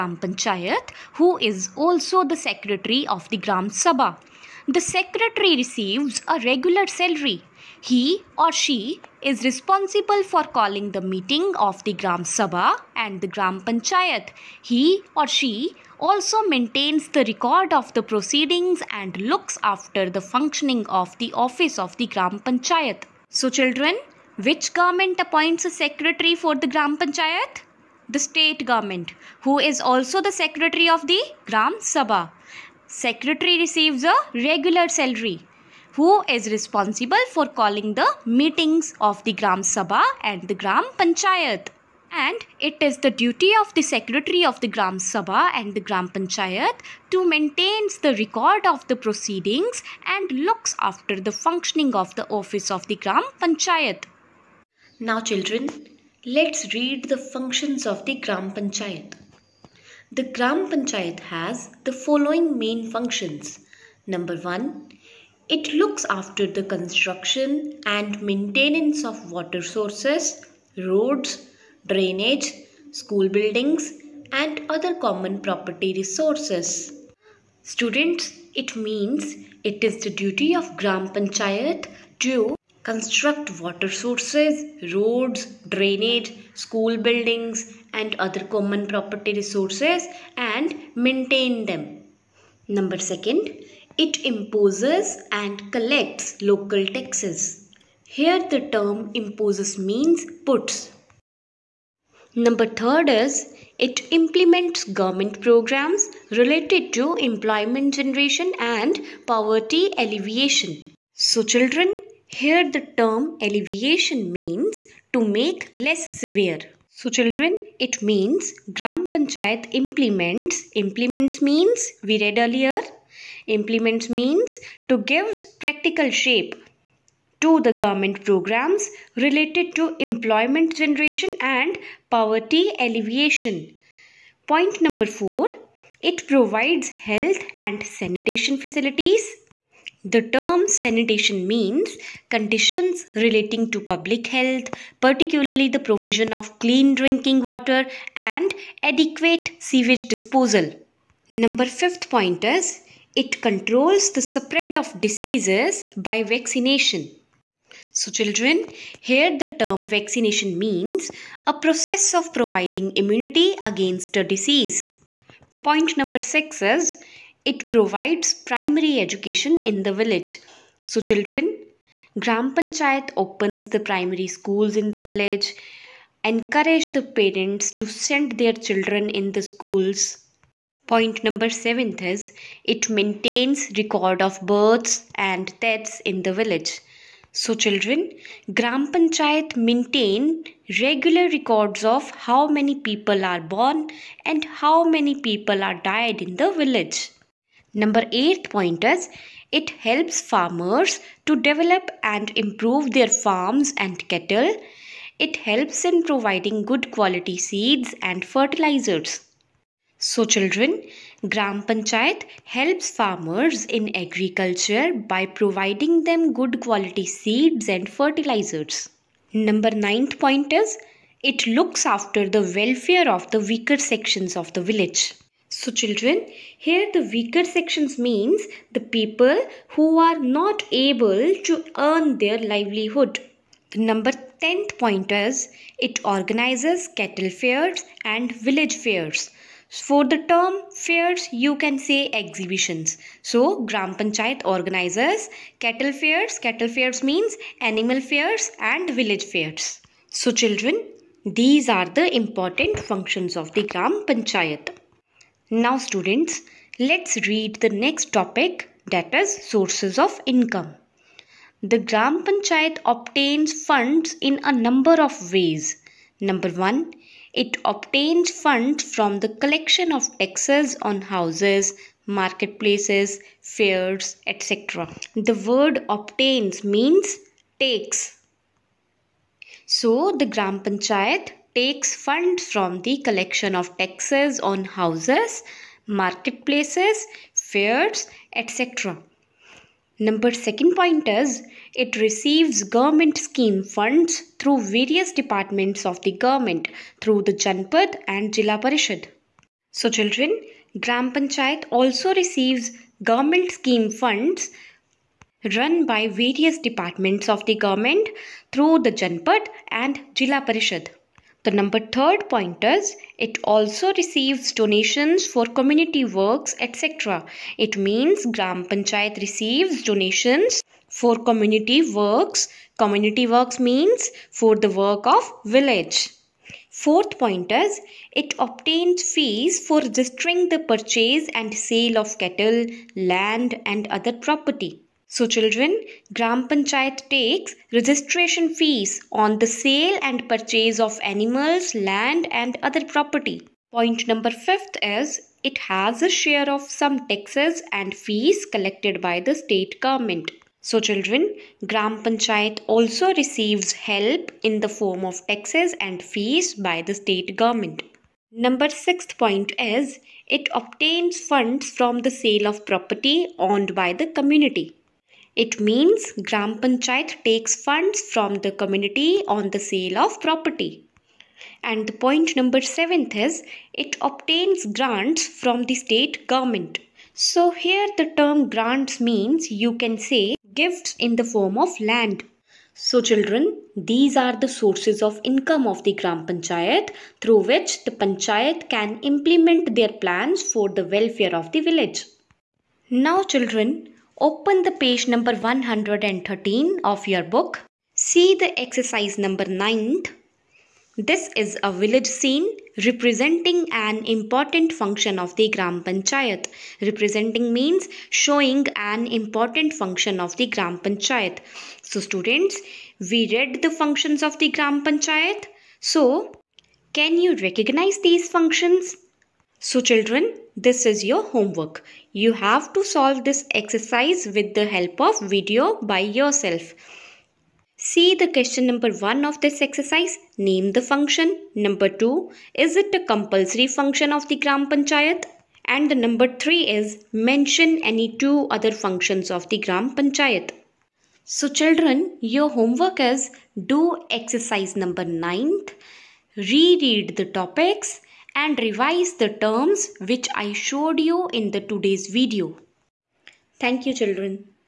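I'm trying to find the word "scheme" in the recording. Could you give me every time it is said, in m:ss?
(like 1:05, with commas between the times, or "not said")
4:53, 5:03.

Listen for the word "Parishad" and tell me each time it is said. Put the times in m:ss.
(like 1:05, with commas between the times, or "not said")
4:58, 5:10.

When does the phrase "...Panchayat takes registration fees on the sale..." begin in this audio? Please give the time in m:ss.
5:36.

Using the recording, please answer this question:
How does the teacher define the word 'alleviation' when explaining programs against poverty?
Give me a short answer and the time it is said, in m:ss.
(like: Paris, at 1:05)
To make less severe, at 1:55.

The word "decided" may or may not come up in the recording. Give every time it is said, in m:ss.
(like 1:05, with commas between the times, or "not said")
not said.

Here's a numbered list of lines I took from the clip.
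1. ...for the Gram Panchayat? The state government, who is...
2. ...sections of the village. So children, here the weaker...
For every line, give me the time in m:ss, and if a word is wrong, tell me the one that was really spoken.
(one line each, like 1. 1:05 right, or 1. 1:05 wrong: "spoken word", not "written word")
1. 0:26 right
2. 3:43 right.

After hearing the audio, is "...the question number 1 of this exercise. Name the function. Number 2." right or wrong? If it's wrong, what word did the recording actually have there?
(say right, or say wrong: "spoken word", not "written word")
right.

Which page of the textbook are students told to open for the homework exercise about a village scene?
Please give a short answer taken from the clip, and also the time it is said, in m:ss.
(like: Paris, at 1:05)
113, at 6:35.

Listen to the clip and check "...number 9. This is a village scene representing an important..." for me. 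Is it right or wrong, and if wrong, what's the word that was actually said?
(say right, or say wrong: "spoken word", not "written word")
right.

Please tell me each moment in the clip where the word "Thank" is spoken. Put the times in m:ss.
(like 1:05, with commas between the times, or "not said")
7:33.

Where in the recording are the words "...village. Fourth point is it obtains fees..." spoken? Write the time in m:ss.
5:25.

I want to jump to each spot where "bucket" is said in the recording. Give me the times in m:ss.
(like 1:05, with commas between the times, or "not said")
not said.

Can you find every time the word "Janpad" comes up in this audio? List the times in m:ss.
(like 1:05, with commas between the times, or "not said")
4:57, 5:08.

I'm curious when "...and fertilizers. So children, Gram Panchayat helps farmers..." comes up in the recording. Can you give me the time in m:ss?
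3:28.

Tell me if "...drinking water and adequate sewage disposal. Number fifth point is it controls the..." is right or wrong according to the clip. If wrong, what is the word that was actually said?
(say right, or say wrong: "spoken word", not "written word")
right.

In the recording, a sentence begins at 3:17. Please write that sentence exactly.
Number eight point is it helps farmers to develop and improve their farms and cattle.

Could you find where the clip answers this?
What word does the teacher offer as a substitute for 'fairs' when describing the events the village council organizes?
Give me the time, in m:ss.
4:02.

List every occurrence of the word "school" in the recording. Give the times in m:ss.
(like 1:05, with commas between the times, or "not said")
1:12, 1:26, 2:54, 2:59.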